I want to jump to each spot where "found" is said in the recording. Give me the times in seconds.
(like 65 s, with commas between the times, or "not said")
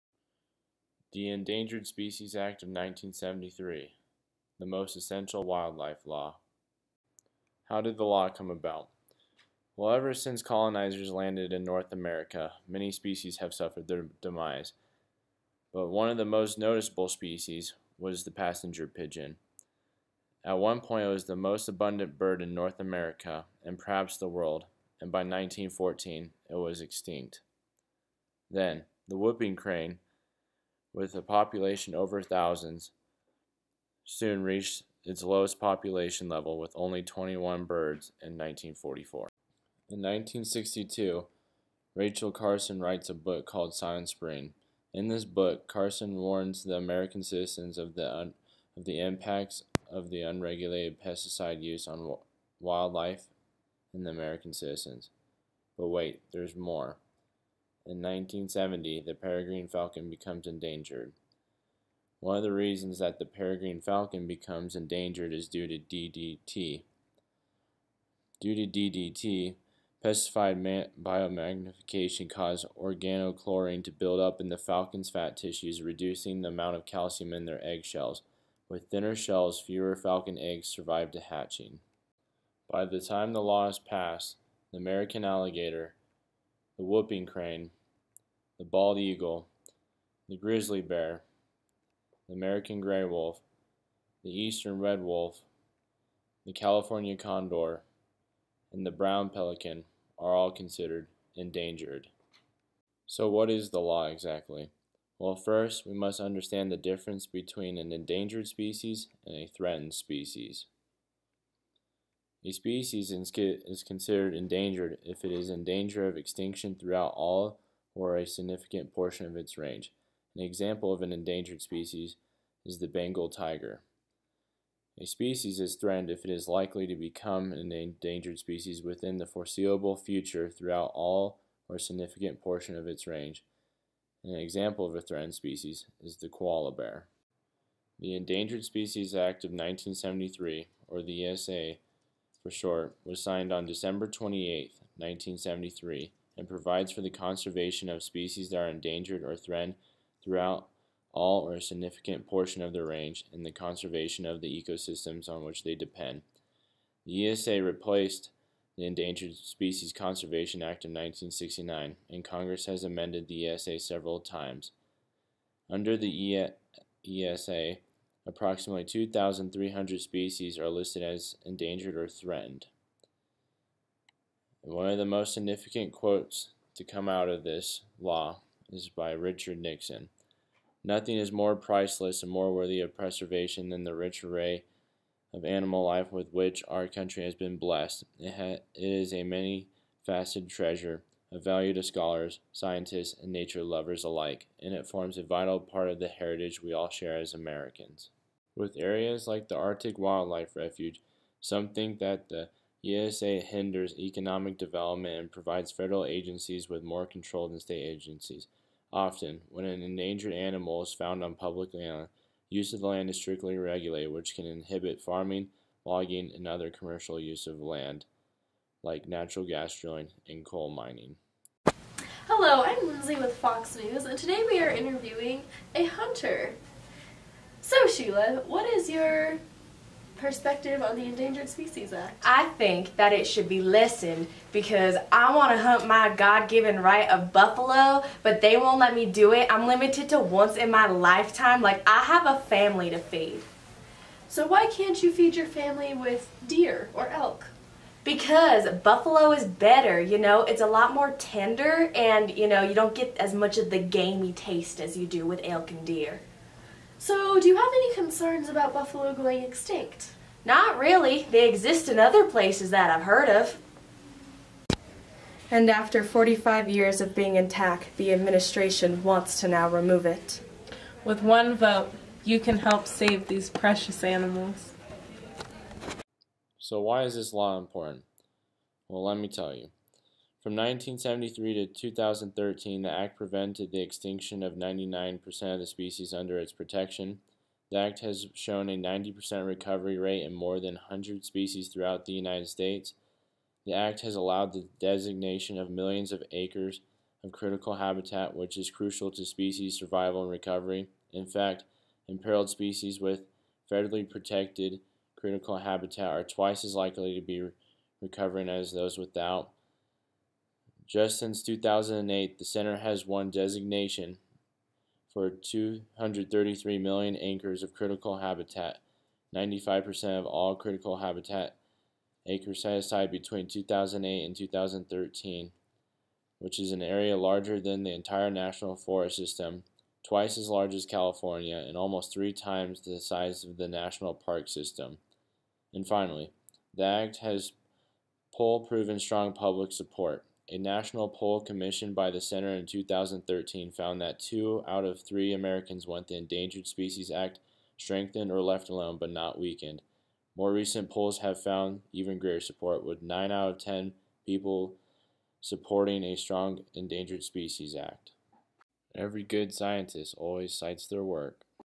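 210 s, 343 s, 351 s.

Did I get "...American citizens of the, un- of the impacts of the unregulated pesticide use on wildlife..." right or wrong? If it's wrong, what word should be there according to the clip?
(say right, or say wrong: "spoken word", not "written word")
right.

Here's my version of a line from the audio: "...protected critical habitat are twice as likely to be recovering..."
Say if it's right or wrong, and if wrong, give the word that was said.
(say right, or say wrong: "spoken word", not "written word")
right.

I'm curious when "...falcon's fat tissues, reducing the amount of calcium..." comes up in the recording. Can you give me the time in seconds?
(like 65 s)
74 s.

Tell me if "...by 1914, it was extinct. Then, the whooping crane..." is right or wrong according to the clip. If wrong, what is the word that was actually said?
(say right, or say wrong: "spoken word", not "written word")
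right.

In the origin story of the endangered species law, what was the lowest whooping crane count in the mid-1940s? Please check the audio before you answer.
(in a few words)
21.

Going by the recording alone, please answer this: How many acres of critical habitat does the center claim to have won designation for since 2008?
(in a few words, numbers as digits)
233 million acres.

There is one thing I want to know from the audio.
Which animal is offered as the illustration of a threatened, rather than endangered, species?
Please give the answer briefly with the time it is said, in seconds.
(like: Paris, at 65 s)
koala bear, at 136 s.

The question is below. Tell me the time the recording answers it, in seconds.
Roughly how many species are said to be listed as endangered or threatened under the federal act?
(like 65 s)
168 s.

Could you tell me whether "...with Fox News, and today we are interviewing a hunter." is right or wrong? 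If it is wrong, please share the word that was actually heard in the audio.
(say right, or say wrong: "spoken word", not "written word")
right.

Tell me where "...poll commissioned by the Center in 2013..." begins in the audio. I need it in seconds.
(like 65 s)
341 s.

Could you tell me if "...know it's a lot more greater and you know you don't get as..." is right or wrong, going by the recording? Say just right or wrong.
wrong.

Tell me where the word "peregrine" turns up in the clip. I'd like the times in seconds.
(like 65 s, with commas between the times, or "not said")
59 s, 63 s.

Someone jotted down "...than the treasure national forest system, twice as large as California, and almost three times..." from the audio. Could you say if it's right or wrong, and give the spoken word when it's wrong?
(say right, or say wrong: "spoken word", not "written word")
wrong: "entire", not "treasure".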